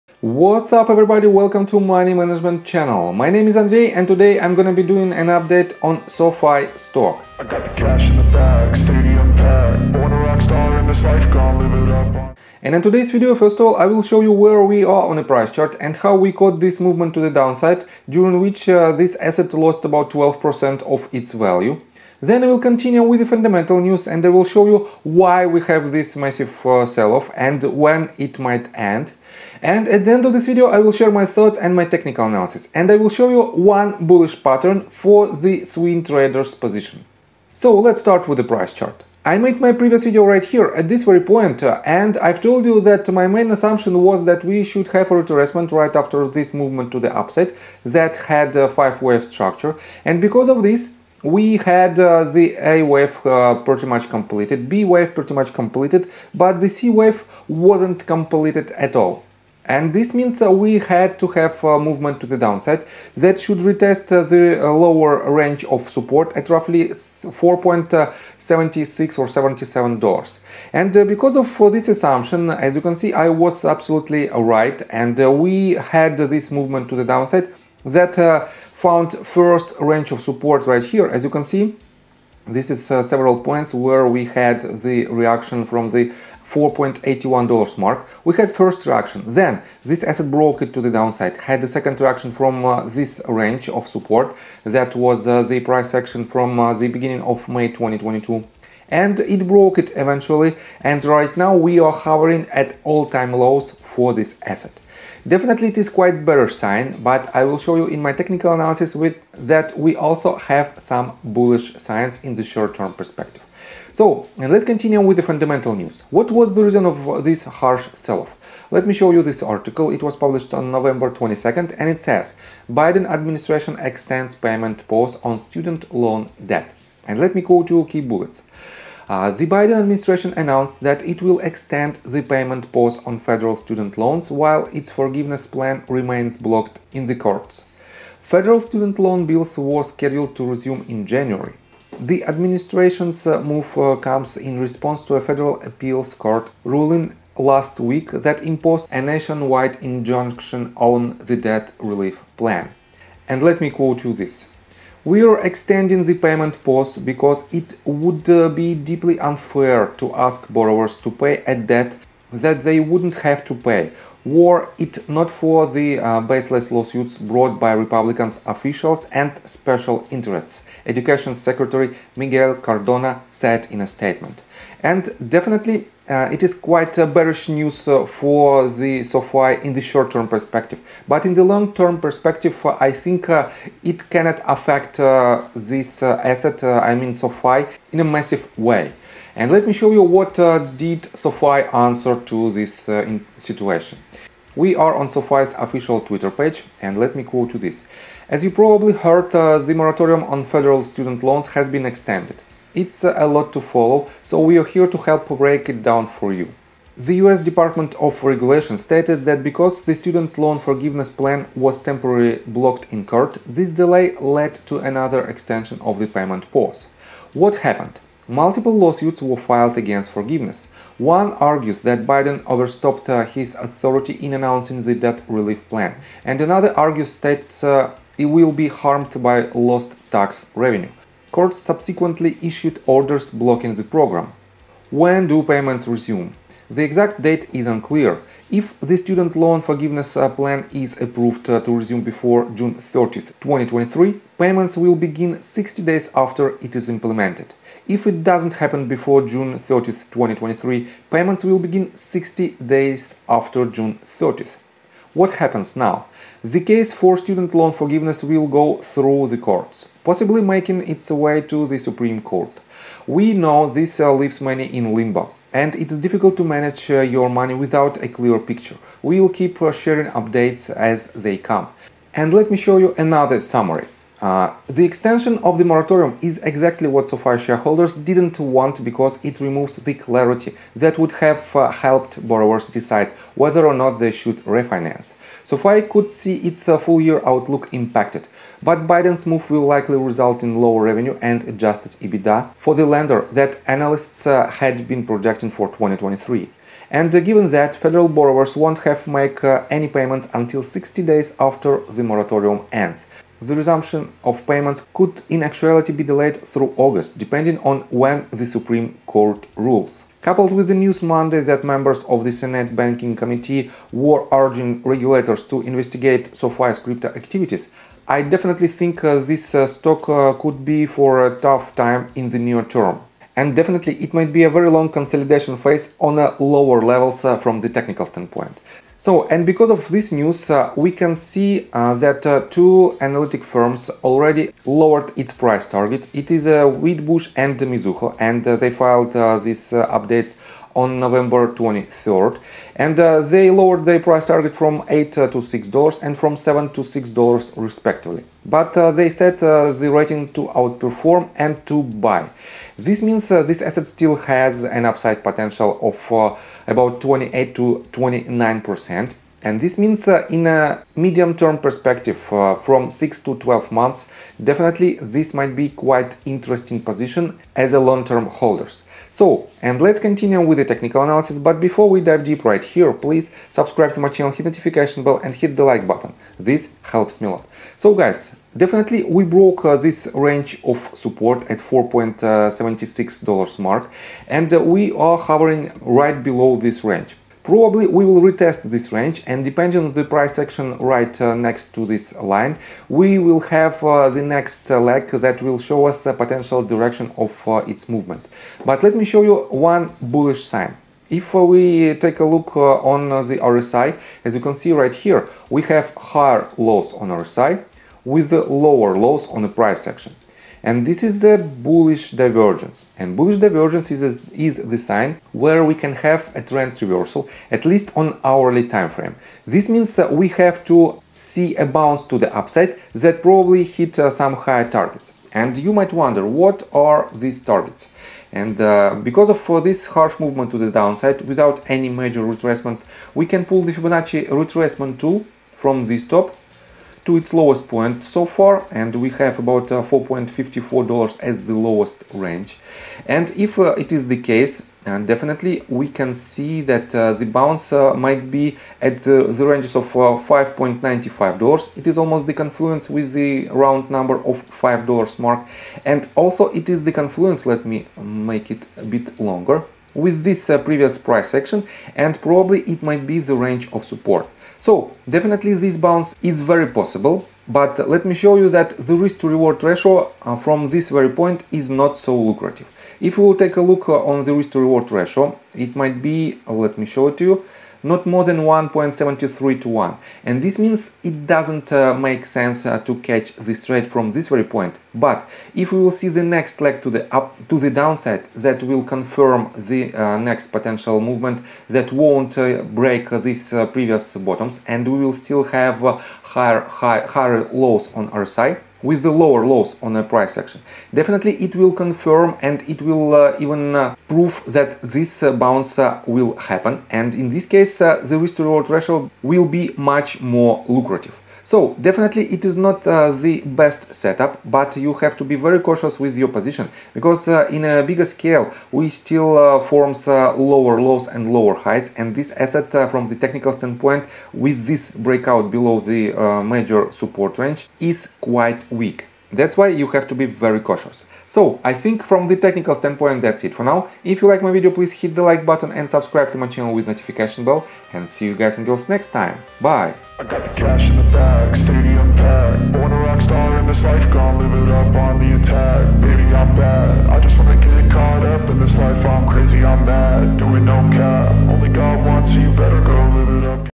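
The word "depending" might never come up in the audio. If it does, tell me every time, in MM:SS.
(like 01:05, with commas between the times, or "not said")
05:07, 06:29.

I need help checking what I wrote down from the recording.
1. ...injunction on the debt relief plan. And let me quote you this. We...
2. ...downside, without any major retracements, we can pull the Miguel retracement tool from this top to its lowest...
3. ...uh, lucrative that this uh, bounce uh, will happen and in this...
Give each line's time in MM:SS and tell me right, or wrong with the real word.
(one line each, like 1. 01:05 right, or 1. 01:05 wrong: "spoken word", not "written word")
1. 02:29 right
2. 07:10 wrong: "Fibonacci", not "Miguel"
3. 08:23 wrong: "prove", not "lucrative".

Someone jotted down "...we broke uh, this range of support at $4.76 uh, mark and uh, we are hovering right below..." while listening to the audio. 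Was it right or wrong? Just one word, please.
right.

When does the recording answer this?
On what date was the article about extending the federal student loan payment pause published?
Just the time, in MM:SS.
02:00.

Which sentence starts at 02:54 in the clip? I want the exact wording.
And definitely, uh, it is quite uh, bearish news uh, for the SoFi in the short-term perspective.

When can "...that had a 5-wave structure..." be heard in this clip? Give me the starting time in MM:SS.
00:47.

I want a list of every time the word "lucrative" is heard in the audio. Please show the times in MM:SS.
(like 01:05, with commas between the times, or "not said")
07:52, 08:30.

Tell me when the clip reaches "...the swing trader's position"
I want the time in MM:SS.
00:35.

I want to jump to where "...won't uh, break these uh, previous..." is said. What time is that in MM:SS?
08:11.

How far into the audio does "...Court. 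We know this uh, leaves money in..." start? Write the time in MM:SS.
04:22.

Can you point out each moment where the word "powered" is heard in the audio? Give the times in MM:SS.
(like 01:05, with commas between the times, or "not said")
not said.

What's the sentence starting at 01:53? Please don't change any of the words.
So let's continue with the fundamental news.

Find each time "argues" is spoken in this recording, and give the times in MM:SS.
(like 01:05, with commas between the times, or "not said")
03:41, 03:46.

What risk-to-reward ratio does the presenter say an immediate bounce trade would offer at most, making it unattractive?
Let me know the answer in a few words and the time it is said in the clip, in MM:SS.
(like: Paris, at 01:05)
1.73 to 1, at 07:58.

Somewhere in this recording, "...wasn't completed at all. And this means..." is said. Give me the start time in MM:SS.
00:57.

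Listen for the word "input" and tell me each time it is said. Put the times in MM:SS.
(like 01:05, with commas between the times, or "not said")
not said.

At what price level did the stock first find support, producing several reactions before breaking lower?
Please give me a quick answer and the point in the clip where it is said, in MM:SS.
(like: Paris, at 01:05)
$4.81, at 01:26.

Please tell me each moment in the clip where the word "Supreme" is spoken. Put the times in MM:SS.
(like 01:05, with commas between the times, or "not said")
04:21, 05:08.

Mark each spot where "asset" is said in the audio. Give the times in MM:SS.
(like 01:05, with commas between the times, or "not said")
00:19, 01:30, 01:44, 03:06, 05:53, 08:42.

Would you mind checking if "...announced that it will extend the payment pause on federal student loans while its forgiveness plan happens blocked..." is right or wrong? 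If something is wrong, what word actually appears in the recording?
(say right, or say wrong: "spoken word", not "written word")
wrong: "remains", not "happens".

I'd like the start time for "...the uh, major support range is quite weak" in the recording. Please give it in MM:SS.
08:45.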